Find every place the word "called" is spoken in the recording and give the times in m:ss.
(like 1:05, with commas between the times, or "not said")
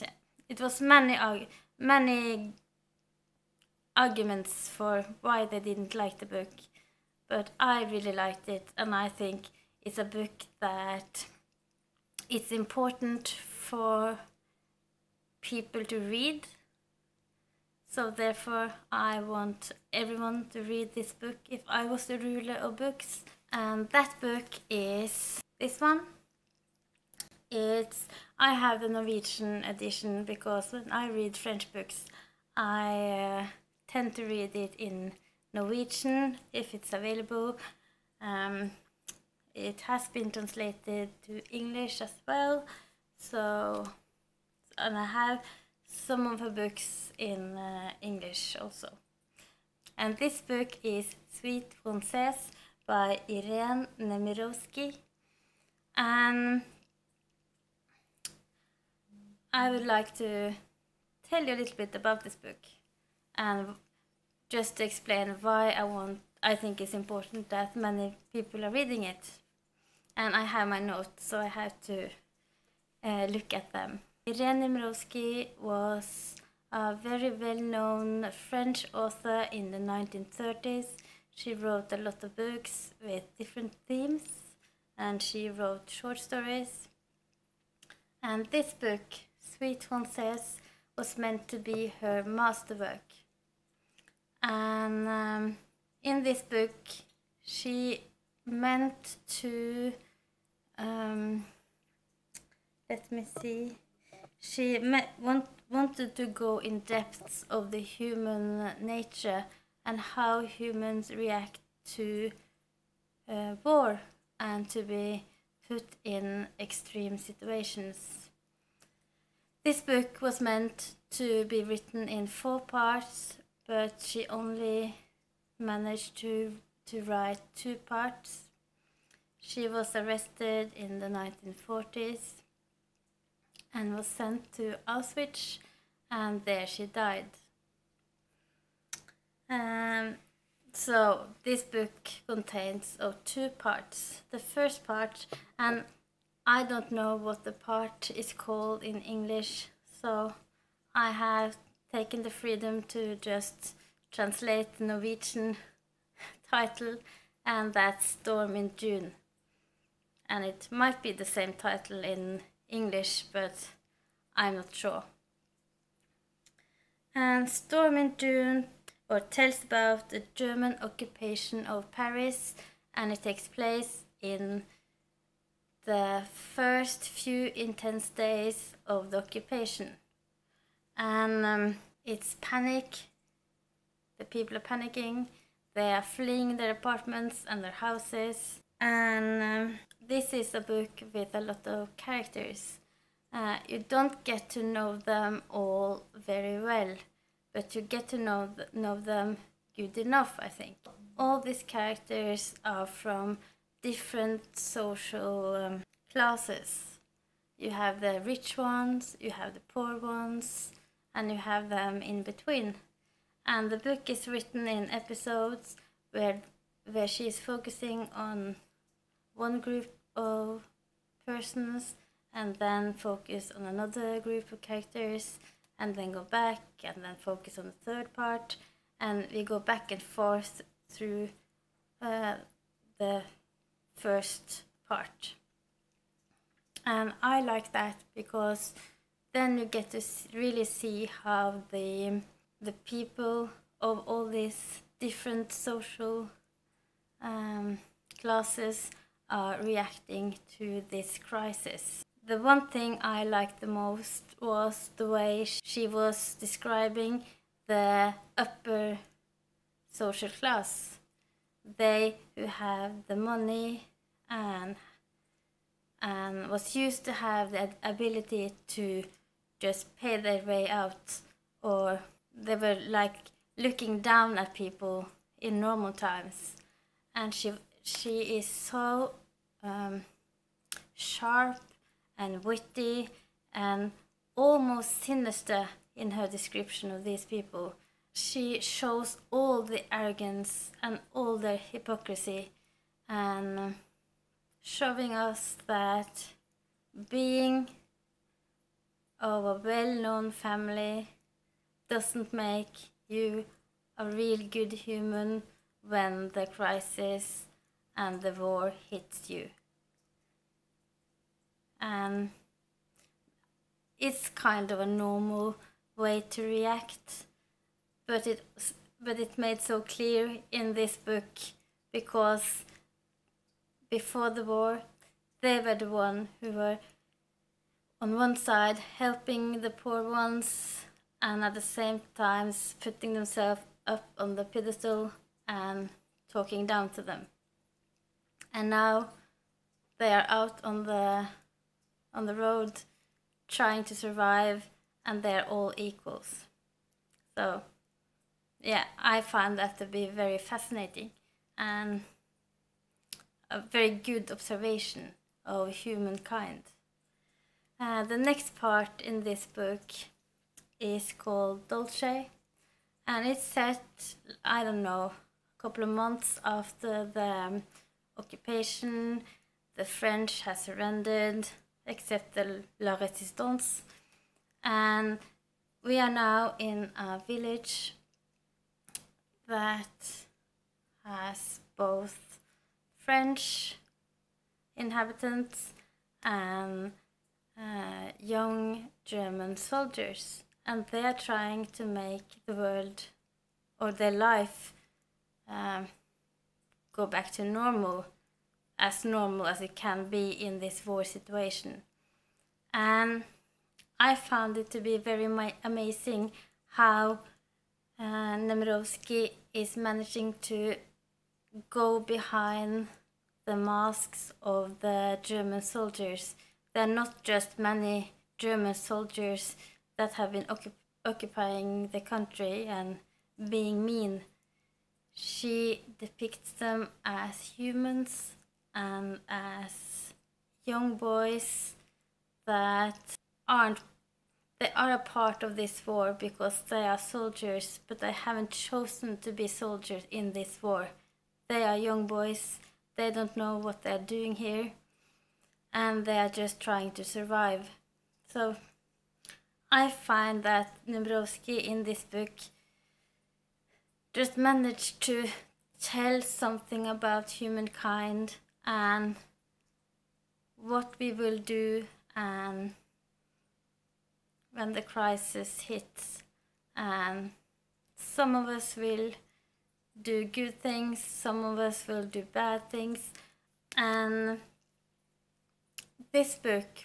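2:28, 6:01.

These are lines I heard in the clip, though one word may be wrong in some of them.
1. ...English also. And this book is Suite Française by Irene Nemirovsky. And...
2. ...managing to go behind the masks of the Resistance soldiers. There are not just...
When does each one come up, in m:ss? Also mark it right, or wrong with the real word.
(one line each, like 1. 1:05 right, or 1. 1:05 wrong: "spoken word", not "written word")
1. 0:48 right
2. 6:49 wrong: "German", not "Resistance".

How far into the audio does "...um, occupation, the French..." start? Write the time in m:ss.
6:07.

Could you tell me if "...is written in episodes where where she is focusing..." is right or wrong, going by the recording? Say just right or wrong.
right.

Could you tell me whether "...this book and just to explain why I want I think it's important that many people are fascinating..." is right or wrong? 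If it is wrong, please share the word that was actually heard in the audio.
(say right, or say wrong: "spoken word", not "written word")
wrong: "reading", not "fascinating".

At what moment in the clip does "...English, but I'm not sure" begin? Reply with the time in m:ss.
2:42.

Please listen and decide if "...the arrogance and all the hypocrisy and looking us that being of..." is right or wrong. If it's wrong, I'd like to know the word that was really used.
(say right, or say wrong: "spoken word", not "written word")
wrong: "showing", not "looking".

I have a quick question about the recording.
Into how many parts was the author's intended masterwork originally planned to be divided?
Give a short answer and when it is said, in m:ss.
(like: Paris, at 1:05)
4, at 2:02.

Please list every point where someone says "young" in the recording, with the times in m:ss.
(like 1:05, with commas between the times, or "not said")
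6:28, 7:10, 7:21.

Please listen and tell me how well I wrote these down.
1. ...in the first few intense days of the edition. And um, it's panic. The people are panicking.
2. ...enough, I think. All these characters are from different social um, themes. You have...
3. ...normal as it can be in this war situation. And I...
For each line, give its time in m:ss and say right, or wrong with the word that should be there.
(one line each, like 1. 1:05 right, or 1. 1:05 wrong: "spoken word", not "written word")
1. 2:54 wrong: "occupation", not "edition"
2. 3:20 wrong: "classes", not "themes"
3. 6:39 right.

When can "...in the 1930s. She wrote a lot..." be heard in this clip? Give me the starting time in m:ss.
1:19.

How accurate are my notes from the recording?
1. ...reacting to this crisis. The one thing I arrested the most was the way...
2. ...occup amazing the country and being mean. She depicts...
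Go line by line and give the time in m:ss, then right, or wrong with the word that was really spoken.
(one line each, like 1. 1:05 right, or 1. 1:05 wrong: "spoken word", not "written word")
1. 4:09 wrong: "liked", not "arrested"
2. 7:00 wrong: "occupying", not "amazing".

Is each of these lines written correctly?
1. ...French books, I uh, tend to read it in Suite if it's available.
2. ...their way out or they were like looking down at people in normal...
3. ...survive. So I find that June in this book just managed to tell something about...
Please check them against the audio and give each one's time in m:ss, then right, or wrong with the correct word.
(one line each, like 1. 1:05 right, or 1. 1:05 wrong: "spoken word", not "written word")
1. 0:31 wrong: "Norwegian", not "Suite"
2. 4:30 right
3. 7:27 wrong: "Nemirovsky", not "June".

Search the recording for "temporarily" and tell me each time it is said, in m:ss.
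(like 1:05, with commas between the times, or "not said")
not said.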